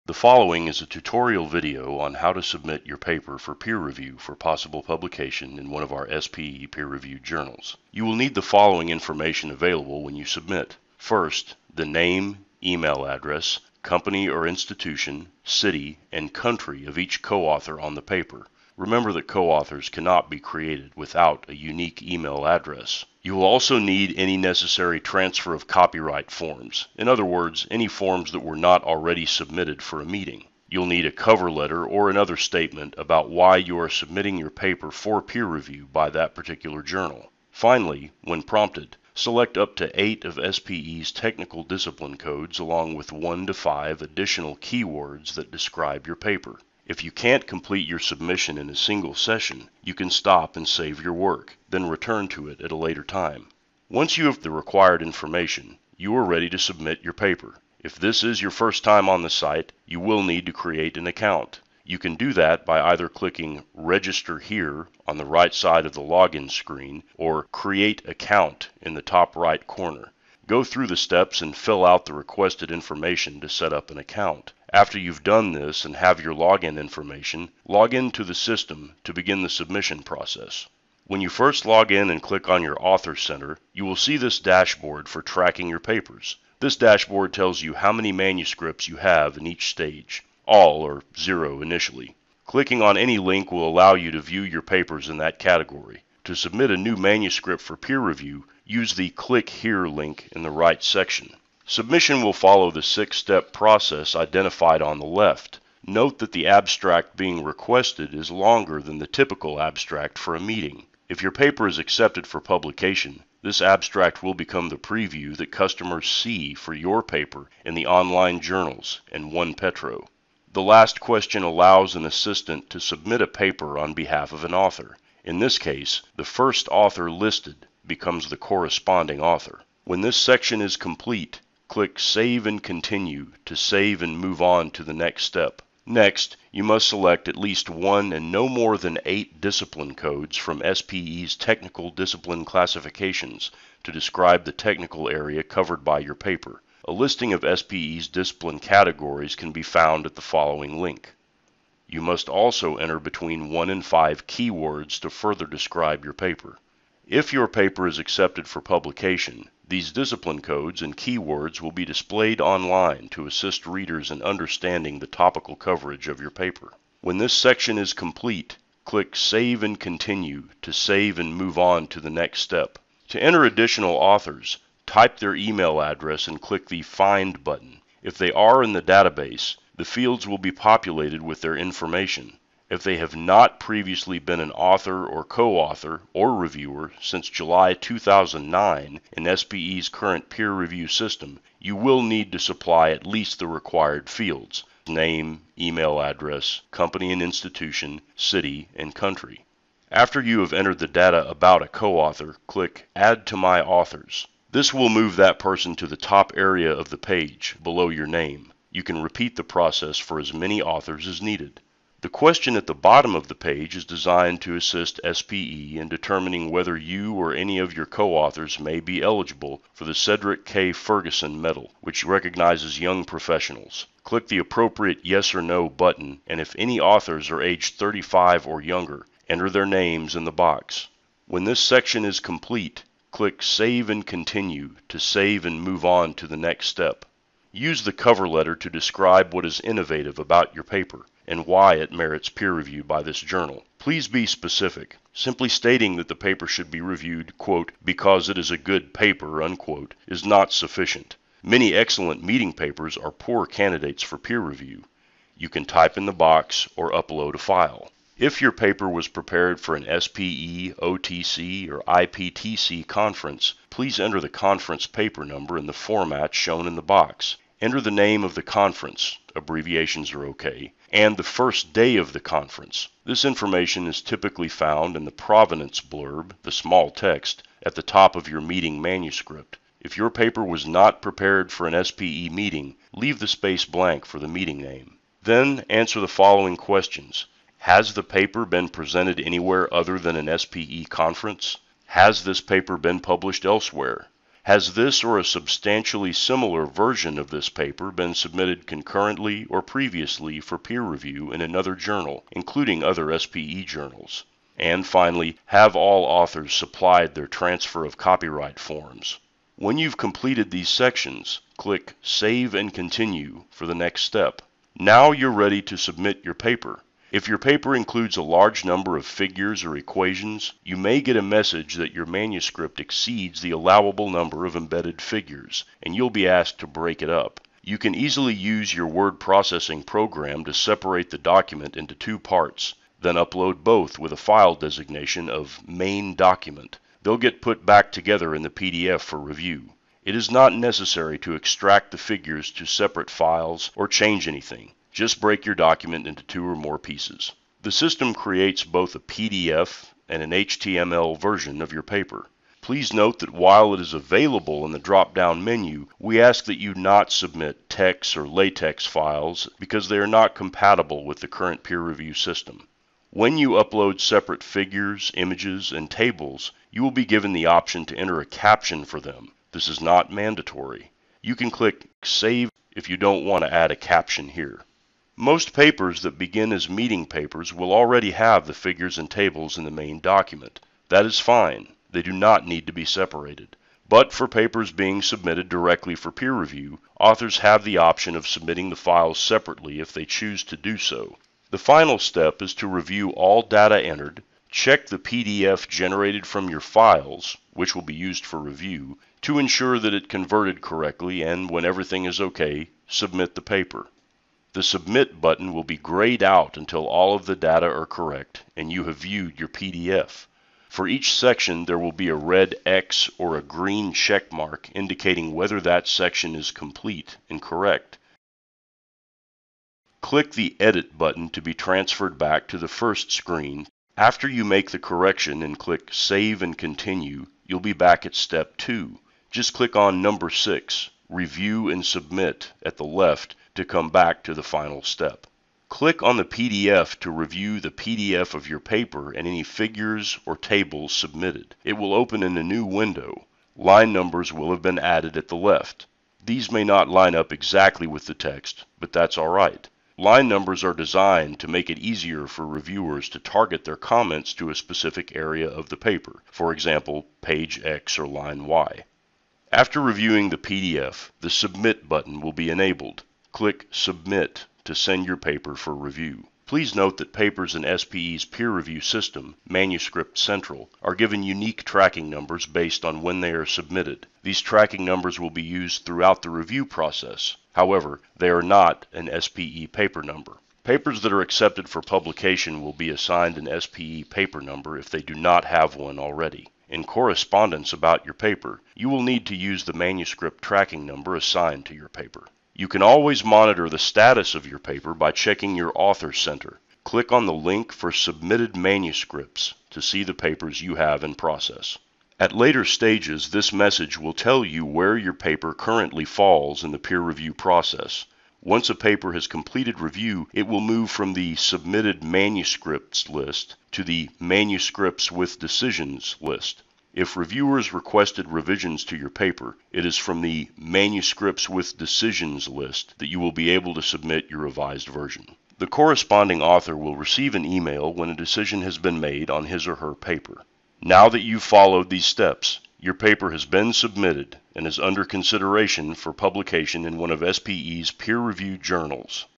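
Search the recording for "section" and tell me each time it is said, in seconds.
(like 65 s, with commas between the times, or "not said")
100 s, 130 s, 167 s, 231 s, 310 s, 411 s, 415 s.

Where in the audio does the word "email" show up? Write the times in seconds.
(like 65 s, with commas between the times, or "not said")
12 s, 22 s, 175 s, 195 s, 527 s.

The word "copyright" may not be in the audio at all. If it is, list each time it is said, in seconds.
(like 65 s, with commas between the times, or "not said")
25 s, 307 s.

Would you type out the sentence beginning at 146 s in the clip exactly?
A listing of SPE's discipline categories can be found at the following link.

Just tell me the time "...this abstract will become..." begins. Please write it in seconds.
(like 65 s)
113 s.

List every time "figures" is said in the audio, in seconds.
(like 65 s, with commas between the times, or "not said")
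319 s, 325 s, 341 s, 364 s, 378 s, 439 s.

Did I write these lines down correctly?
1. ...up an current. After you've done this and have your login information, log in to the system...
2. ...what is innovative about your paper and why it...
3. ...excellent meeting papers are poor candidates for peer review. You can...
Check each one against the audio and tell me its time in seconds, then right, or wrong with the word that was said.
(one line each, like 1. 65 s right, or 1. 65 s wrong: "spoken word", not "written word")
1. 73 s wrong: "account", not "current"
2. 239 s right
3. 251 s right.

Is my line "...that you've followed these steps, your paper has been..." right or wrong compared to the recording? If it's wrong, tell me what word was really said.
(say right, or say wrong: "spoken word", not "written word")
right.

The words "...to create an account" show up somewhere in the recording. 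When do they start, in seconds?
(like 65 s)
60 s.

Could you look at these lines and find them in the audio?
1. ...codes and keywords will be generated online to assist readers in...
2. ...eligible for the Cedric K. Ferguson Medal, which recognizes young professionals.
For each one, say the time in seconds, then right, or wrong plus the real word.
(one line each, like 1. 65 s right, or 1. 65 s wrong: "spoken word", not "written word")
1. 160 s wrong: "displayed", not "generated"
2. 219 s right.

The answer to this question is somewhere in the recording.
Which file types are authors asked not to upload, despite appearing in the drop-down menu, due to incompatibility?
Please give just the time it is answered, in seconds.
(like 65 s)
357 s.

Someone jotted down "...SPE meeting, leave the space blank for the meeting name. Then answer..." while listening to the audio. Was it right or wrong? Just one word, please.
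right.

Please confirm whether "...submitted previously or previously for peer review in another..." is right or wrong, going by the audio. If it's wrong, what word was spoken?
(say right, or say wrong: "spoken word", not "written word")
wrong: "concurrently", not "previously".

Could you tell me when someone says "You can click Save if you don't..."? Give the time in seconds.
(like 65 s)
371 s.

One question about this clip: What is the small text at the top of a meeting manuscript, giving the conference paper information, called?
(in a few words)
provenance blurb.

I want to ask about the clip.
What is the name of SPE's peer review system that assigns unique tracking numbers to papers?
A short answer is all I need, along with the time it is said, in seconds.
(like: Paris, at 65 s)
Manuscript Central, at 469 s.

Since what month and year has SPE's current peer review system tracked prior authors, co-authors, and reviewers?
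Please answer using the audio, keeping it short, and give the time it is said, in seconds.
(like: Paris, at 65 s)
July 2009, at 187 s.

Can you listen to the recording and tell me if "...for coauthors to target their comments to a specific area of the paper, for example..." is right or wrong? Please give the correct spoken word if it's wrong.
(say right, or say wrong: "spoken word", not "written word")
wrong: "reviewers", not "coauthors".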